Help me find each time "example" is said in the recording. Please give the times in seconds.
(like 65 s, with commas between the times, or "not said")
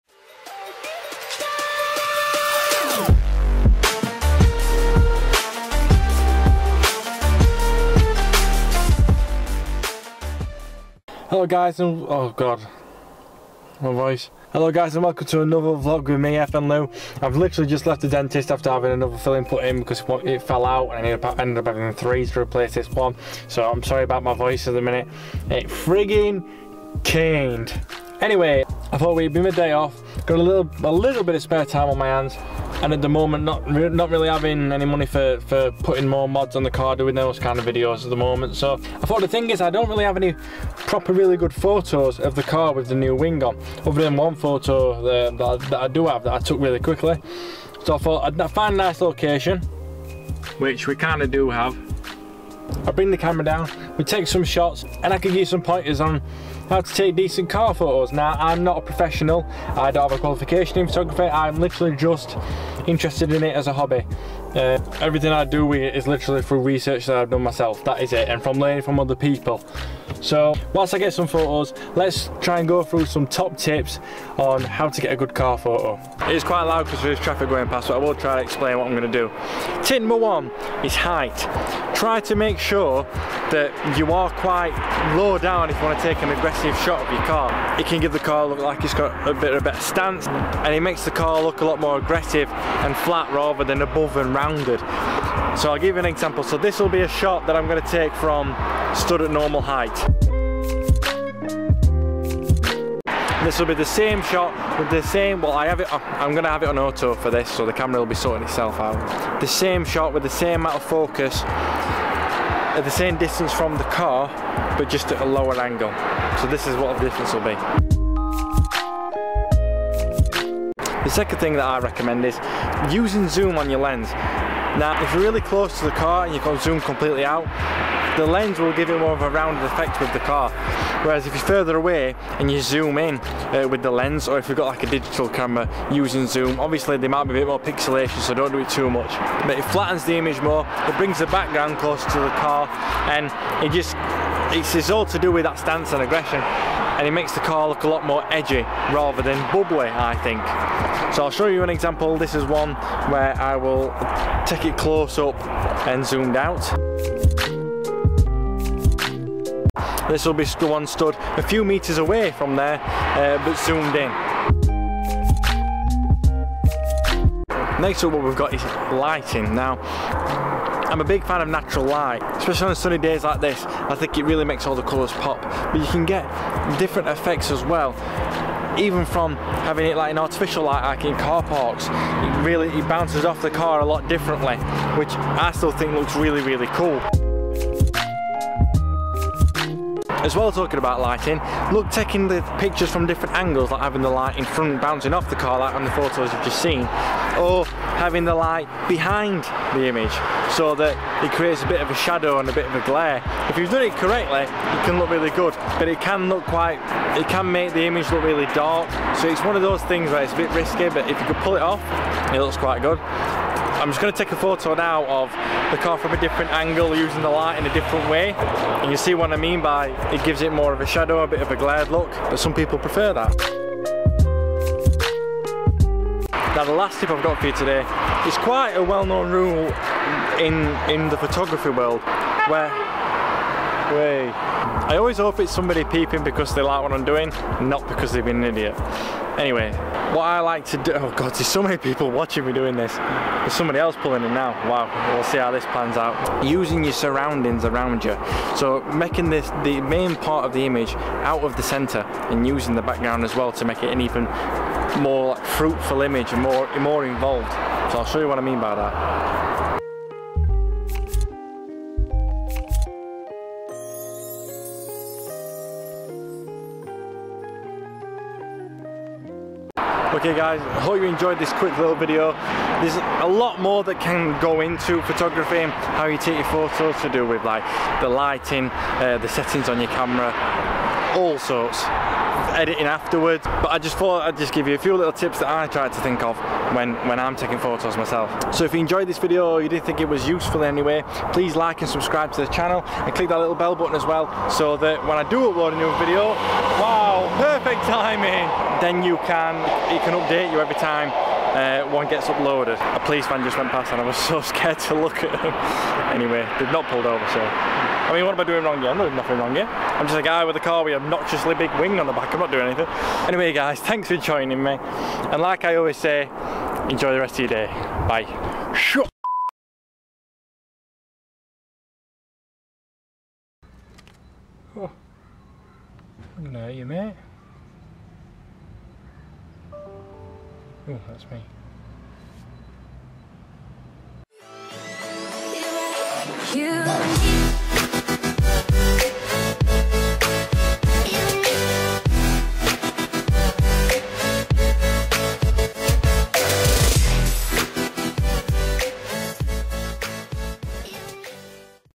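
96 s, 151 s.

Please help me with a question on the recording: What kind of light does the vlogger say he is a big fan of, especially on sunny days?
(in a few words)
natural light.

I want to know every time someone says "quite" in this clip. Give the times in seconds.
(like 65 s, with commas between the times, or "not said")
76 s, 84 s, 206 s, 212 s, 228 s.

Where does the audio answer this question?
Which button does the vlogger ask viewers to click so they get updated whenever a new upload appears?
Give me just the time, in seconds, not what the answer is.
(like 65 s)
293 s.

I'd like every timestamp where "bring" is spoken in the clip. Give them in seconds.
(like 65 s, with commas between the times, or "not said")
52 s, 140 s.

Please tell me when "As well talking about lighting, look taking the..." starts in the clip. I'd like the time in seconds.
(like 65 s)
190 s.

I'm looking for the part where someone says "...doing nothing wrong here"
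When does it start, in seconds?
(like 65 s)
309 s.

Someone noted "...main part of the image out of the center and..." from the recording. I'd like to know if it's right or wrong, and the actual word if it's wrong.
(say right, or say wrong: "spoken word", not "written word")
right.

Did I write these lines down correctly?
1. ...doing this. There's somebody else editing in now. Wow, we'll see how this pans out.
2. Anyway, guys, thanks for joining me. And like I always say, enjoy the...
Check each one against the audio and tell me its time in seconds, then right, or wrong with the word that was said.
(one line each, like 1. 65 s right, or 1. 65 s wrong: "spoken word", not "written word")
1. 242 s wrong: "pulling", not "editing"
2. 313 s right.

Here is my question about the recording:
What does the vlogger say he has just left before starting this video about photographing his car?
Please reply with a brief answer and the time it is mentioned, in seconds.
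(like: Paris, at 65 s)
the dentist, at 18 s.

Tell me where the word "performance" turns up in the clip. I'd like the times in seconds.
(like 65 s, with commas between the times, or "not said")
not said.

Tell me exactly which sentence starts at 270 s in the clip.
Okay guys, I hope you enjoyed this quick little video.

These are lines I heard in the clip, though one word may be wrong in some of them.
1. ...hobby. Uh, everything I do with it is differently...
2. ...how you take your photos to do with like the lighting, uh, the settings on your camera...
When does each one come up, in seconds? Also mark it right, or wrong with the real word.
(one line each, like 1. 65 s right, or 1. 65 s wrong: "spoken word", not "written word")
1. 63 s wrong: "literally", not "differently"
2. 275 s right.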